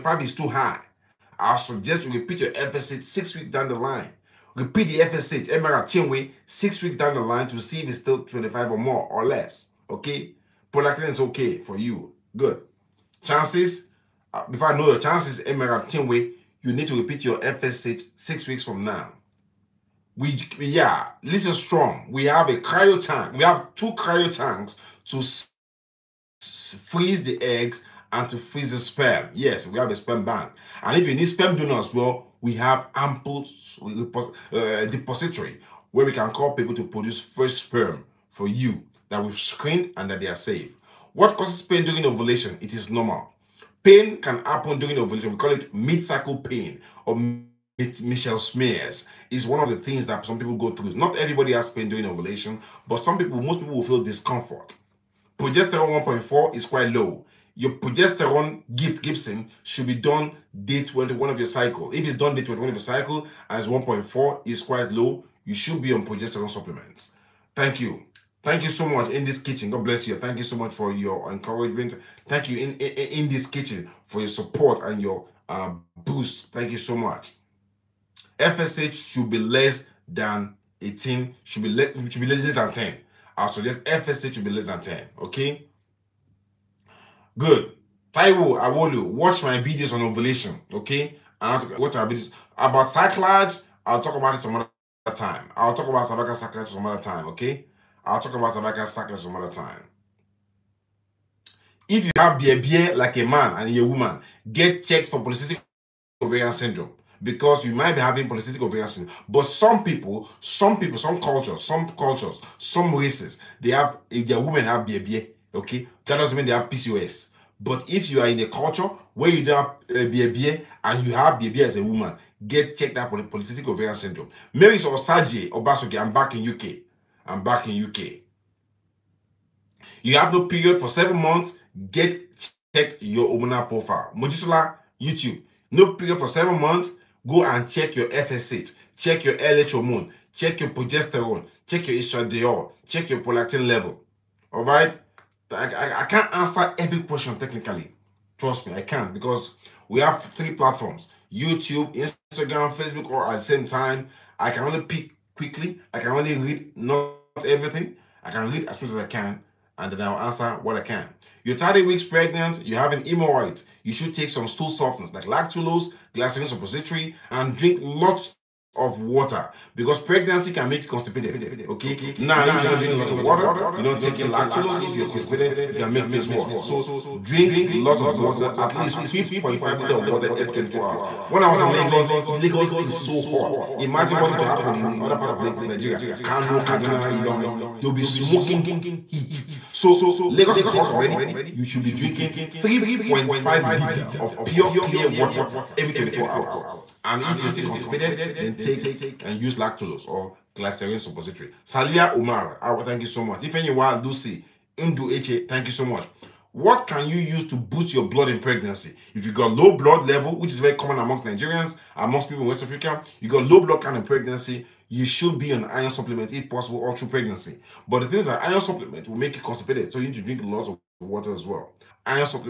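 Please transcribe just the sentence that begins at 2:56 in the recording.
So drink lots of water, at least 3.5 liter of water every 24 hours.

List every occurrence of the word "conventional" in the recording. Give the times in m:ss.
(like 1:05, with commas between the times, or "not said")
not said.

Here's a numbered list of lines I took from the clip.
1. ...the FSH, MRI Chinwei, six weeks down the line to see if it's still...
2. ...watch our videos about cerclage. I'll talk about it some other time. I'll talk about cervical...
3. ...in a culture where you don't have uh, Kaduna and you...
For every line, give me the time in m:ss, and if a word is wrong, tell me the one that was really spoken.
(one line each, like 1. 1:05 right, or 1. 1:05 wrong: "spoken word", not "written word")
1. 0:04 right
2. 1:31 right
3. 1:58 wrong: "BABA", not "Kaduna".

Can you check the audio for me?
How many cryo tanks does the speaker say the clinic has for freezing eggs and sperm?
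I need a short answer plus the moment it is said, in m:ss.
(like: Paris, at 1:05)
2, at 0:23.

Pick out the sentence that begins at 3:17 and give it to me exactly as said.
And if you're still constipated, then take and use lactulose or Glycerin Suppository.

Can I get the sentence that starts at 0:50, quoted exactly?
Not everybody has pain during ovulation, but some people, most people will feel discomfort.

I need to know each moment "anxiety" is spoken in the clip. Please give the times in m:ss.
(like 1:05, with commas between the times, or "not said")
not said.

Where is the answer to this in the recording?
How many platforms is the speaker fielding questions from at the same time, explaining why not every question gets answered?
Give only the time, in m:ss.
2:30.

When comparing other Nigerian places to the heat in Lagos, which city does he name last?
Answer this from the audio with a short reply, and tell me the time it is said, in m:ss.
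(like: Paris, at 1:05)
Ilorin, at 3:07.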